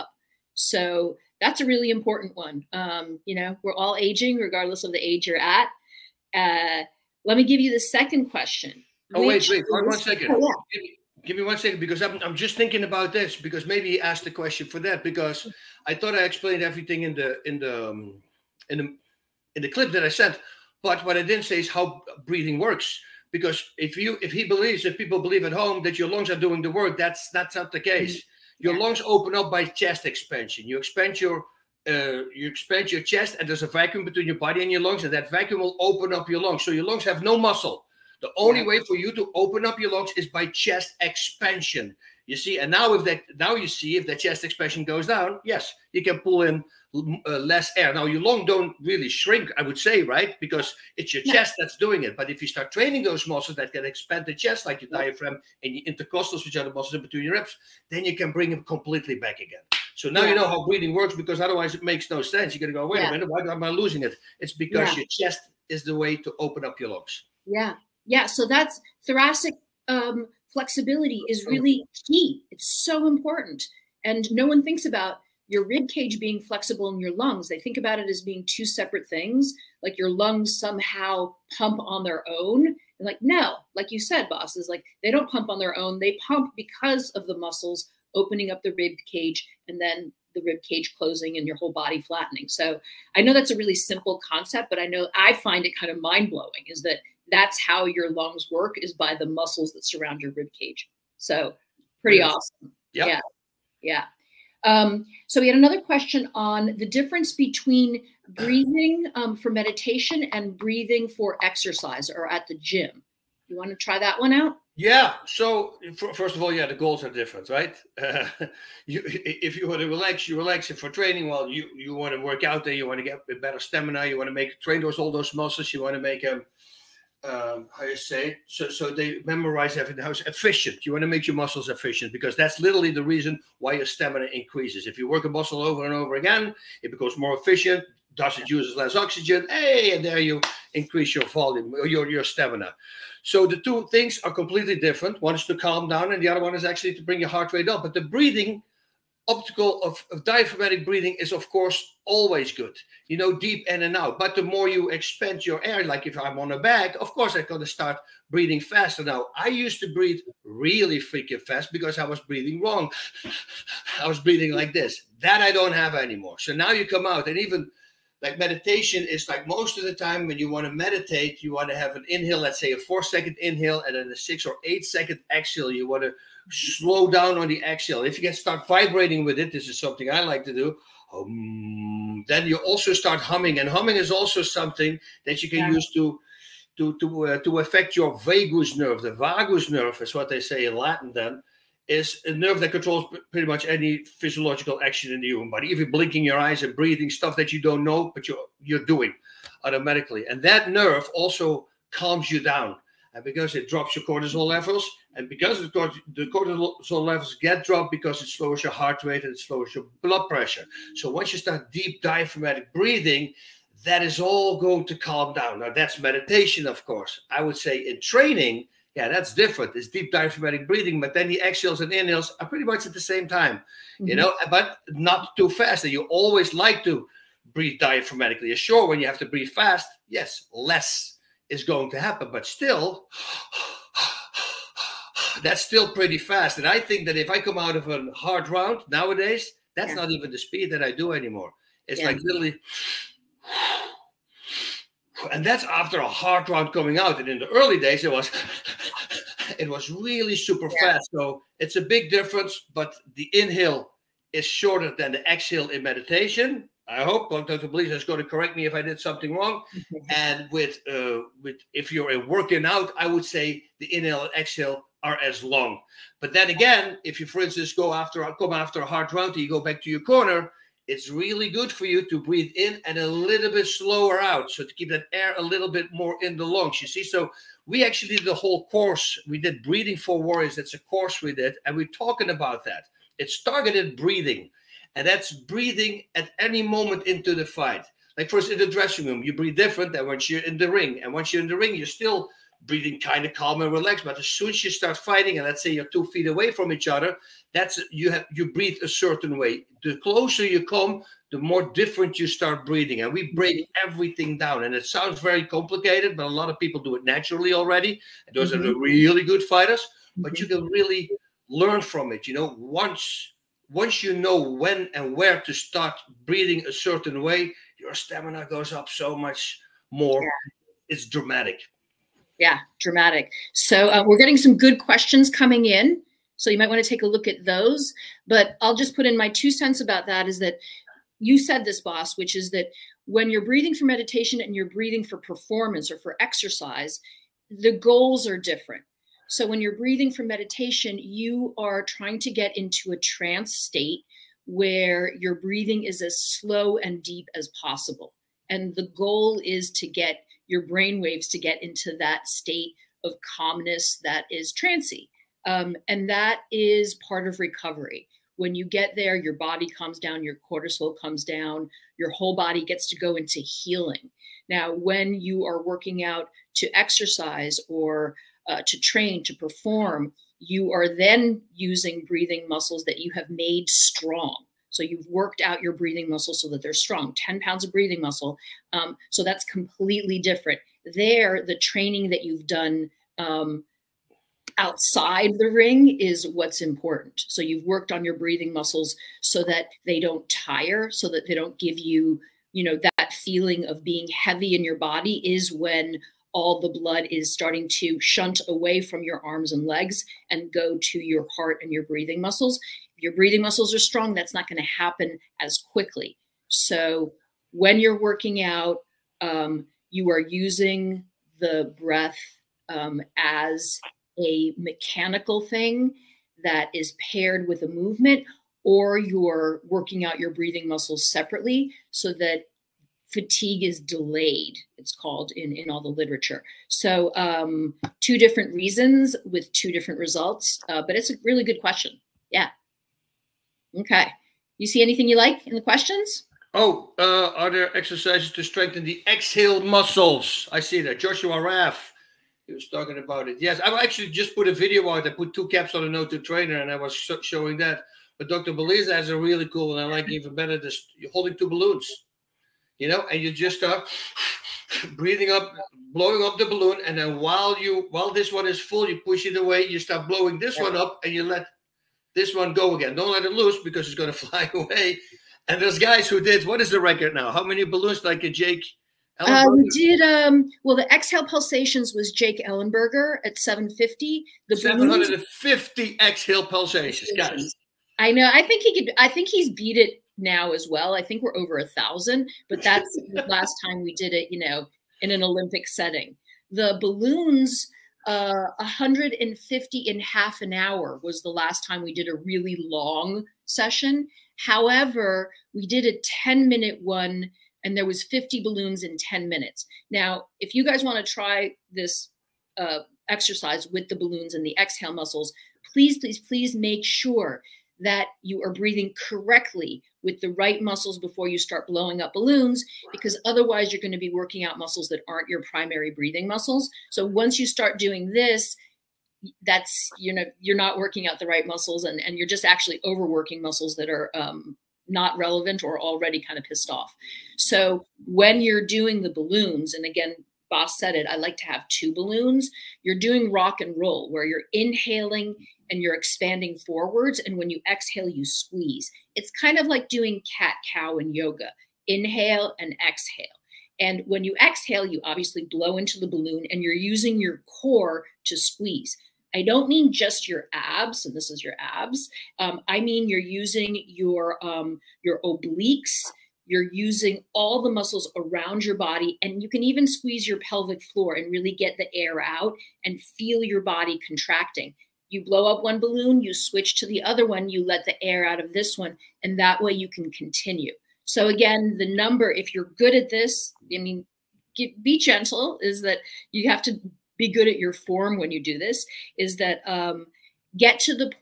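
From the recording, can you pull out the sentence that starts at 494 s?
However, we did a 10 minute one and there was 50 balloons in 10 minutes.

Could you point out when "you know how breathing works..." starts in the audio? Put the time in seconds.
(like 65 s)
60 s.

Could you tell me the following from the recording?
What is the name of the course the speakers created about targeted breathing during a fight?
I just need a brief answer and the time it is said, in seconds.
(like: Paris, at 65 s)
Breathing for Warriors, at 279 s.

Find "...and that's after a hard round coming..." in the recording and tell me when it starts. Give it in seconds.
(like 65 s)
245 s.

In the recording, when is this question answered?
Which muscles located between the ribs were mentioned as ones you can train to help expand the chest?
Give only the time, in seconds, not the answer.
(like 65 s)
55 s.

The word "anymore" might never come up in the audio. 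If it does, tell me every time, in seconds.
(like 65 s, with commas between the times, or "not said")
165 s, 241 s.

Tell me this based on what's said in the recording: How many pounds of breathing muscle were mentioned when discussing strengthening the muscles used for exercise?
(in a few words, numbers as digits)
10.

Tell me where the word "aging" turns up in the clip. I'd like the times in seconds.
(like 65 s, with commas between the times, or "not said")
3 s.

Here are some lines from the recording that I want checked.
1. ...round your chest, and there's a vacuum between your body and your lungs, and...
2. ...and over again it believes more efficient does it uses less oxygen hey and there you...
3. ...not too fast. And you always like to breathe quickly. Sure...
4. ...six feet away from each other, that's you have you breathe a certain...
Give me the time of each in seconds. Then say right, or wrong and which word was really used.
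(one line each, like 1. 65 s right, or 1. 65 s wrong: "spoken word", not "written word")
1. 32 s wrong: "expand", not "round"
2. 135 s wrong: "becomes", not "believes"
3. 224 s wrong: "diaphragmatically", not "quickly"
4. 295 s wrong: "two", not "six".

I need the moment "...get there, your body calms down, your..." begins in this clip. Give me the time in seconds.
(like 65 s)
358 s.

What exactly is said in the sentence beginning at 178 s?
If you can start vibrating with it, this is something I like to do.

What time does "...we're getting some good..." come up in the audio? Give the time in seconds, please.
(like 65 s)
324 s.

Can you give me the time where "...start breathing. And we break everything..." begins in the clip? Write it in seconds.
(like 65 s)
302 s.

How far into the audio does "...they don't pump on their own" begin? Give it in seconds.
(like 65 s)
85 s.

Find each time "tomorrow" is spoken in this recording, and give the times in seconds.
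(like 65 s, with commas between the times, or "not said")
not said.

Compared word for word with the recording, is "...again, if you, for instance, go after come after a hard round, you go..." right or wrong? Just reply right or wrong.
right.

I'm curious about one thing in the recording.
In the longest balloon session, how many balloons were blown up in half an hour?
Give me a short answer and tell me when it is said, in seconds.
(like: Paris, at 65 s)
150, at 488 s.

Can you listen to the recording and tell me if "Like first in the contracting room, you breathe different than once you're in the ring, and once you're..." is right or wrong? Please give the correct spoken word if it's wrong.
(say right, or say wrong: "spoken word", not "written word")
wrong: "dressing", not "contracting".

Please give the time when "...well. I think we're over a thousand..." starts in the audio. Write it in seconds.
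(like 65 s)
480 s.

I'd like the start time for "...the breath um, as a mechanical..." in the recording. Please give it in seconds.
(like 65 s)
411 s.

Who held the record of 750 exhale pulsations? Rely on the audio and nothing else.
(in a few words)
Jake Ellenberger.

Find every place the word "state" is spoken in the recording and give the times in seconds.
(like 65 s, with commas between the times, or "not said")
343 s, 352 s.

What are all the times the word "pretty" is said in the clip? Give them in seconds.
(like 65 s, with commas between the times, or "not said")
102 s, 193 s, 222 s, 235 s.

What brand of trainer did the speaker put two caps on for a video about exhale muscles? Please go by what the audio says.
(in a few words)
O2 trainer.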